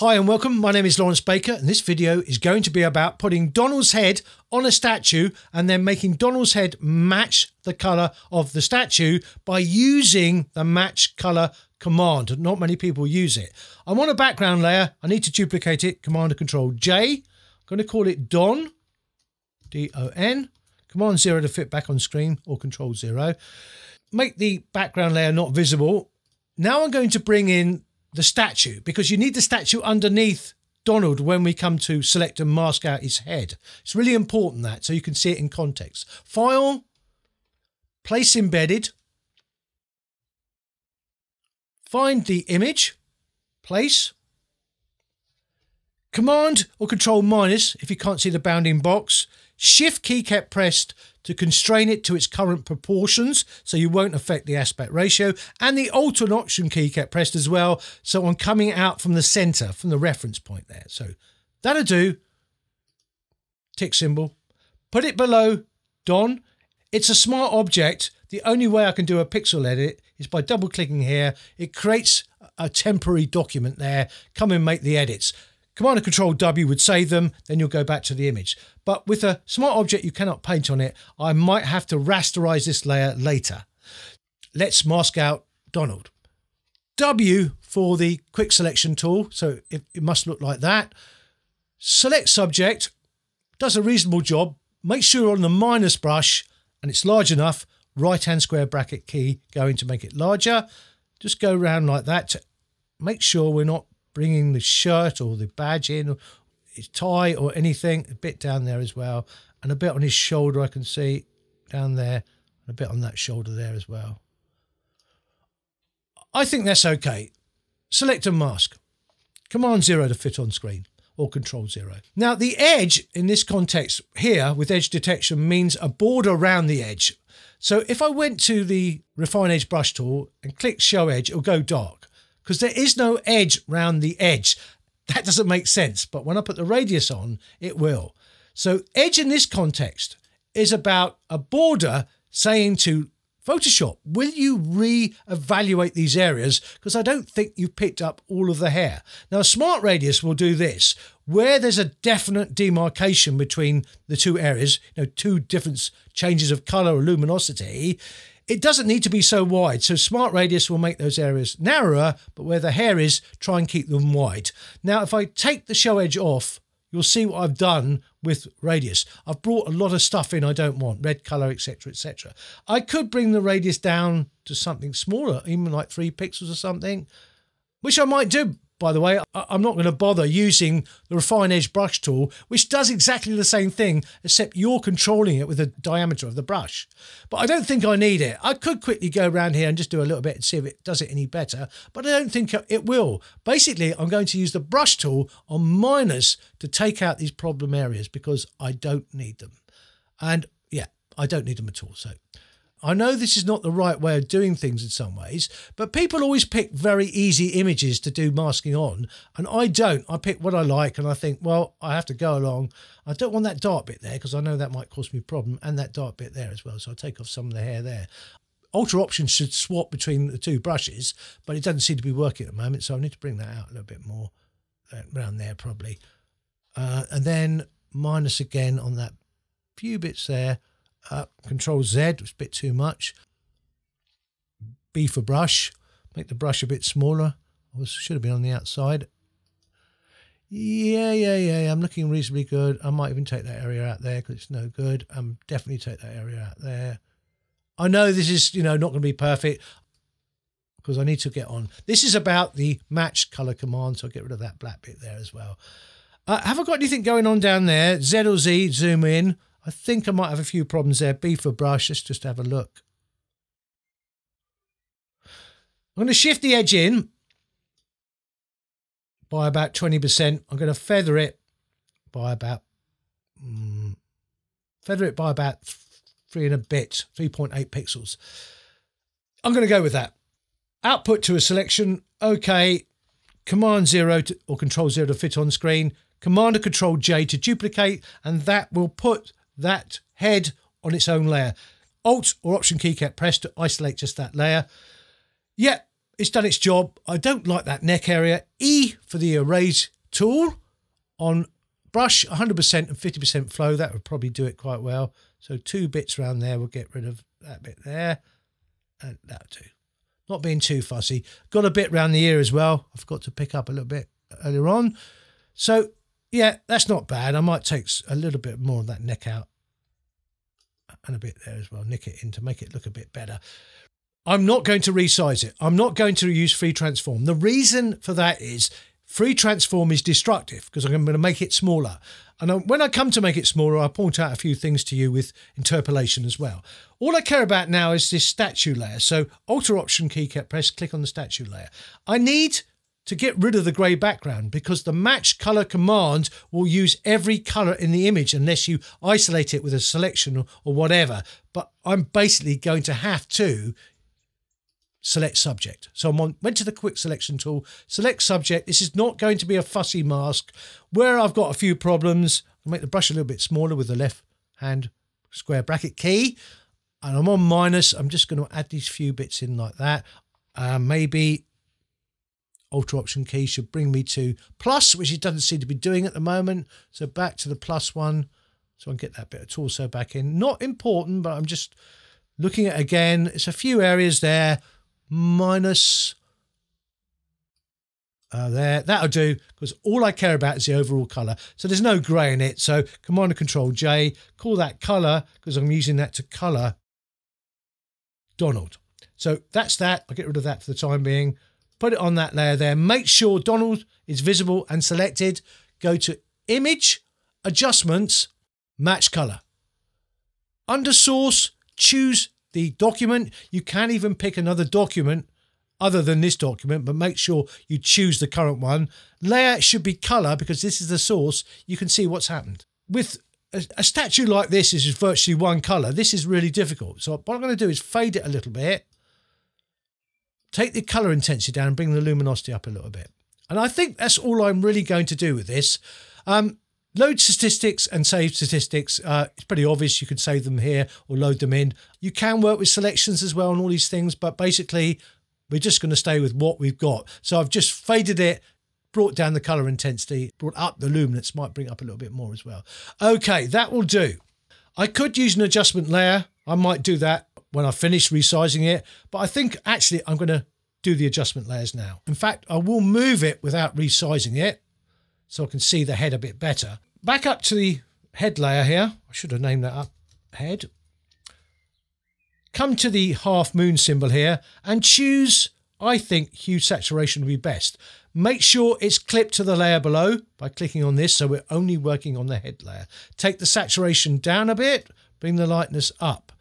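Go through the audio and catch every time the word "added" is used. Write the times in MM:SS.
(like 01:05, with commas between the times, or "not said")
not said.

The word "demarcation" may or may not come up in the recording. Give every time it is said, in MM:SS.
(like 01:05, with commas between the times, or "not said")
02:32.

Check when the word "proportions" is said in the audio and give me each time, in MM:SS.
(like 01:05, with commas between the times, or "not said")
00:52.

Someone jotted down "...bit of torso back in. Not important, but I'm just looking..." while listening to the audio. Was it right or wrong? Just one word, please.
right.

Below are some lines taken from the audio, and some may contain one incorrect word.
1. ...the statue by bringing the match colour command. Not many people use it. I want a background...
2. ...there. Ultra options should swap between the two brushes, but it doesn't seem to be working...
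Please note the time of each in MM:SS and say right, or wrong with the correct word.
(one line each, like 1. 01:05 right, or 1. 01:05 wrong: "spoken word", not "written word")
1. 00:08 wrong: "using", not "bringing"
2. 03:37 right.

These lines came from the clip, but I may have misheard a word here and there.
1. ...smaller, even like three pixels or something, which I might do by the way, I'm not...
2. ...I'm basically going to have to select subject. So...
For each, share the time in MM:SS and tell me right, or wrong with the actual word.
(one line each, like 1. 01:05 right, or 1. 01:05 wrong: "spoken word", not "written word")
1. 02:54 right
2. 05:51 right.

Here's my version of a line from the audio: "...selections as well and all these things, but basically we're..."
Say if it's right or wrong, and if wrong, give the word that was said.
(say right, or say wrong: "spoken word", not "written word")
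right.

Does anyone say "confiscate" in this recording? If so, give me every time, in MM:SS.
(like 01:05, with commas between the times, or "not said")
not said.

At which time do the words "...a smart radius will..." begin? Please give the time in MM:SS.
02:29.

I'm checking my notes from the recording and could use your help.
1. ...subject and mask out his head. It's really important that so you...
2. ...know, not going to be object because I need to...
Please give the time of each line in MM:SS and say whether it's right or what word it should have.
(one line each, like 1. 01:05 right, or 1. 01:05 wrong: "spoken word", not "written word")
1. 00:32 wrong: "select", not "subject"
2. 04:08 wrong: "perfect", not "object".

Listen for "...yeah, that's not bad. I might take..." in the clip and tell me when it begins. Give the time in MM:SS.
05:16.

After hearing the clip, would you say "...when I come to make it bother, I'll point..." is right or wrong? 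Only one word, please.
wrong.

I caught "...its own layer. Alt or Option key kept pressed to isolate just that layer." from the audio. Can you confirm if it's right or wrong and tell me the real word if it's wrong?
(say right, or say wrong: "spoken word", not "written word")
right.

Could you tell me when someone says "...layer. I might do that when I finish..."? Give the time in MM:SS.
07:35.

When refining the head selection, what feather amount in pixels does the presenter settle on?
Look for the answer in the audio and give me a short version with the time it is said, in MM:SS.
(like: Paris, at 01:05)
3.8 pixels, at 04:37.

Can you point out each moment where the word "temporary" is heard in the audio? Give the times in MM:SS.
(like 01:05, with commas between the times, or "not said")
01:12.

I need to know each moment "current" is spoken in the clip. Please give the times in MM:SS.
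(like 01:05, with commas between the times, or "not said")
00:52, 06:58.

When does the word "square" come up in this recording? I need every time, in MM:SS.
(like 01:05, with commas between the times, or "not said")
01:38, 06:05.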